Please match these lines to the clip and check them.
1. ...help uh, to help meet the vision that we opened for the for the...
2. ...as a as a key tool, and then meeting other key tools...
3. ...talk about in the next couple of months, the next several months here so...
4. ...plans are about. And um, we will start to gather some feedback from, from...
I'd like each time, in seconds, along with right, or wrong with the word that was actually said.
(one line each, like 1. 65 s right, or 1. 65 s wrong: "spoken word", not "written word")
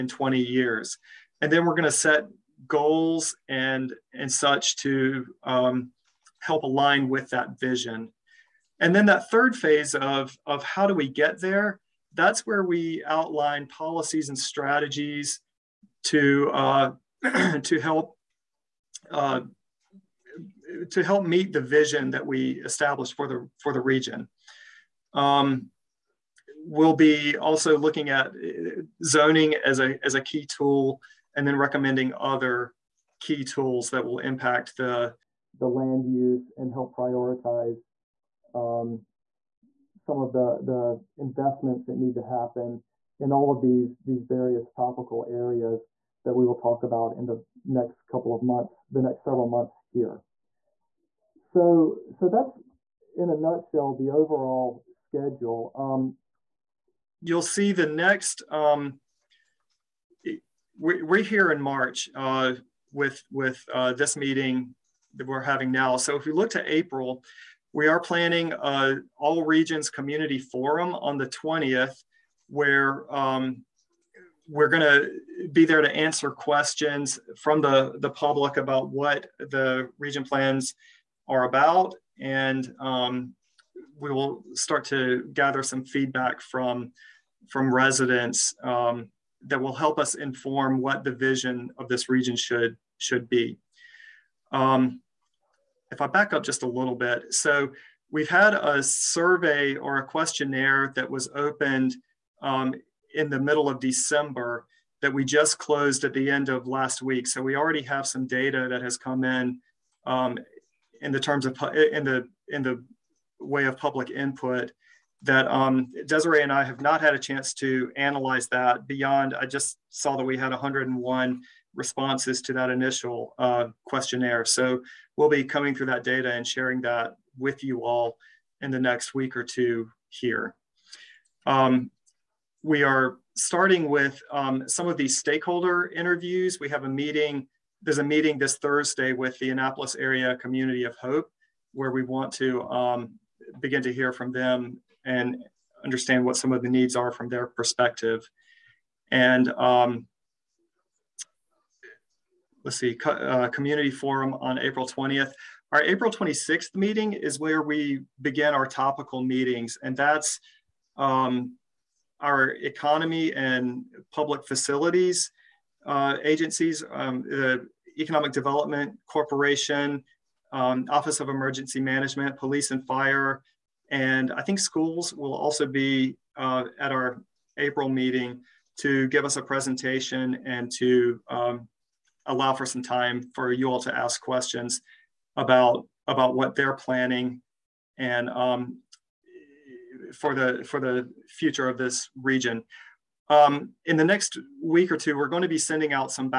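1. 17 s wrong: "established", not "opened"
2. 29 s wrong: "recommending", not "meeting"
3. 46 s right
4. 80 s right.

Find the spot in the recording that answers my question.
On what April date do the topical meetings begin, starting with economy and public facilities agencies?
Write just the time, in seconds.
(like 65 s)
155 s.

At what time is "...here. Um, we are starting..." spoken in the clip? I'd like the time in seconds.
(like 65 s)
130 s.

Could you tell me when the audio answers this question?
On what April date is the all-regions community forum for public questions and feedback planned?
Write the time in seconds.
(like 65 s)
71 s.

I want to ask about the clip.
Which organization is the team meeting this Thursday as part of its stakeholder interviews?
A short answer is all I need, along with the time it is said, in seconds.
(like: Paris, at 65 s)
Annapolis Area Community of Hope, at 139 s.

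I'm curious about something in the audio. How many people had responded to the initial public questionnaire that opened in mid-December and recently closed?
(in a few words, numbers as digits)
101.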